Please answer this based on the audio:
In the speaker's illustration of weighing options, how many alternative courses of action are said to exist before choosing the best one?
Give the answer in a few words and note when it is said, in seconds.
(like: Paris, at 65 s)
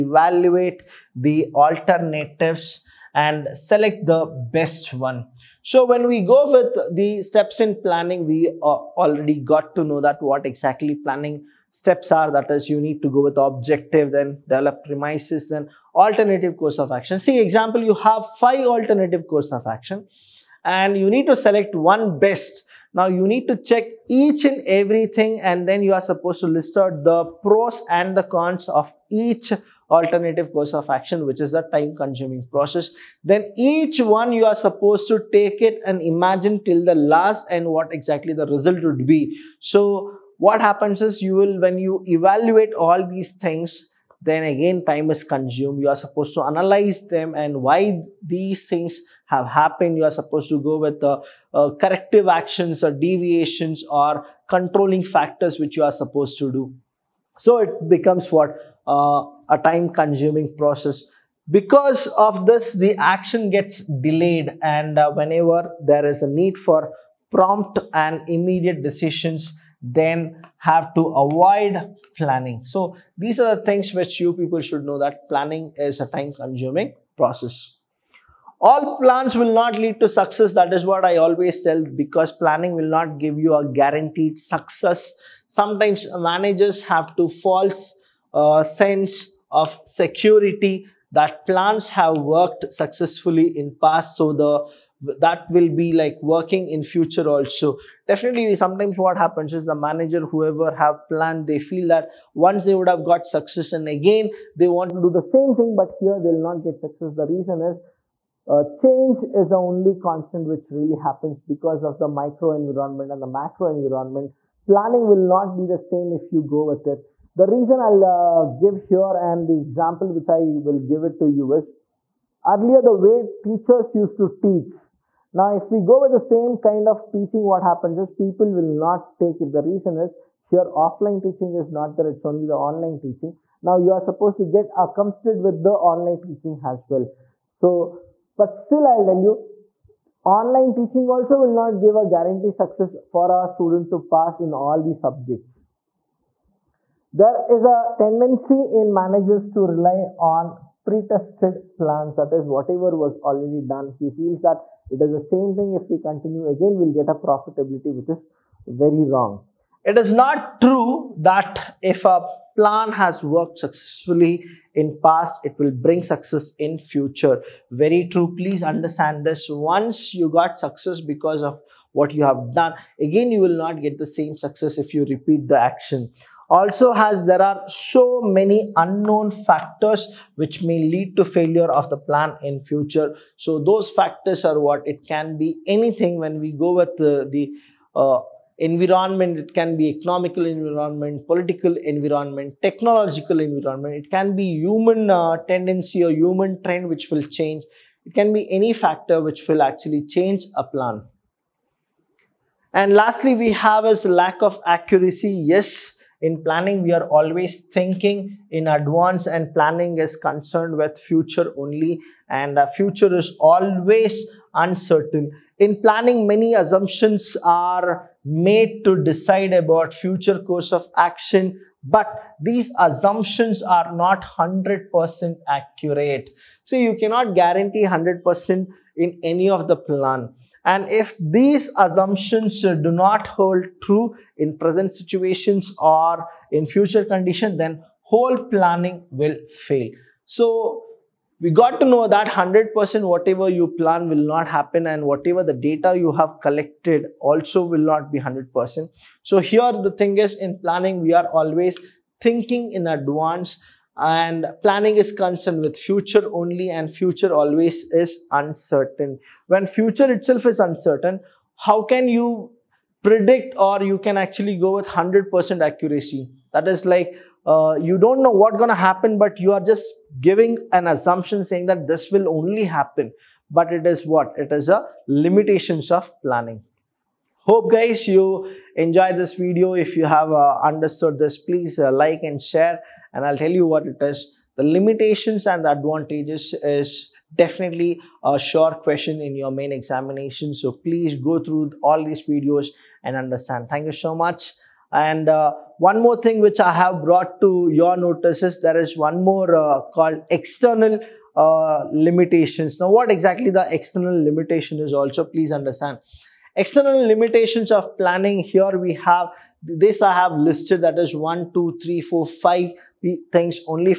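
5, at 18 s.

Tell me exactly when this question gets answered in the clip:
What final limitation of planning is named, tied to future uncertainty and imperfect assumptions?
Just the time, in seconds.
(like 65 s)
204 s.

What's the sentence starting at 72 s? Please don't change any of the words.
So these are the things which you people should know that planning is a time consuming process.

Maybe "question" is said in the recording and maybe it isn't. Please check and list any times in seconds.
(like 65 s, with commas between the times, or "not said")
288 s.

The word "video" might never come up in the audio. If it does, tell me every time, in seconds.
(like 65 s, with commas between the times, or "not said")
279 s, 292 s.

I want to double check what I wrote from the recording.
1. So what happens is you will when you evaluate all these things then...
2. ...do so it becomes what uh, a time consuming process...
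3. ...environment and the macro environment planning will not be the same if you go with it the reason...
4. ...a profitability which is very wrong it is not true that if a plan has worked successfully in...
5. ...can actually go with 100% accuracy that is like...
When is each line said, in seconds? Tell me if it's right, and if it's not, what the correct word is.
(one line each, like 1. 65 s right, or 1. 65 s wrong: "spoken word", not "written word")
1. 39 s right
2. 56 s right
3. 112 s right
4. 157 s right
5. 263 s right.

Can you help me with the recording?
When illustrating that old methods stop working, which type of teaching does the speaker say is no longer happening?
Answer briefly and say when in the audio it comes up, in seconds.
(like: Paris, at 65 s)
offline teaching, at 130 s.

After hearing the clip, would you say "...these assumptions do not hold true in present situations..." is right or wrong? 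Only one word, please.
right.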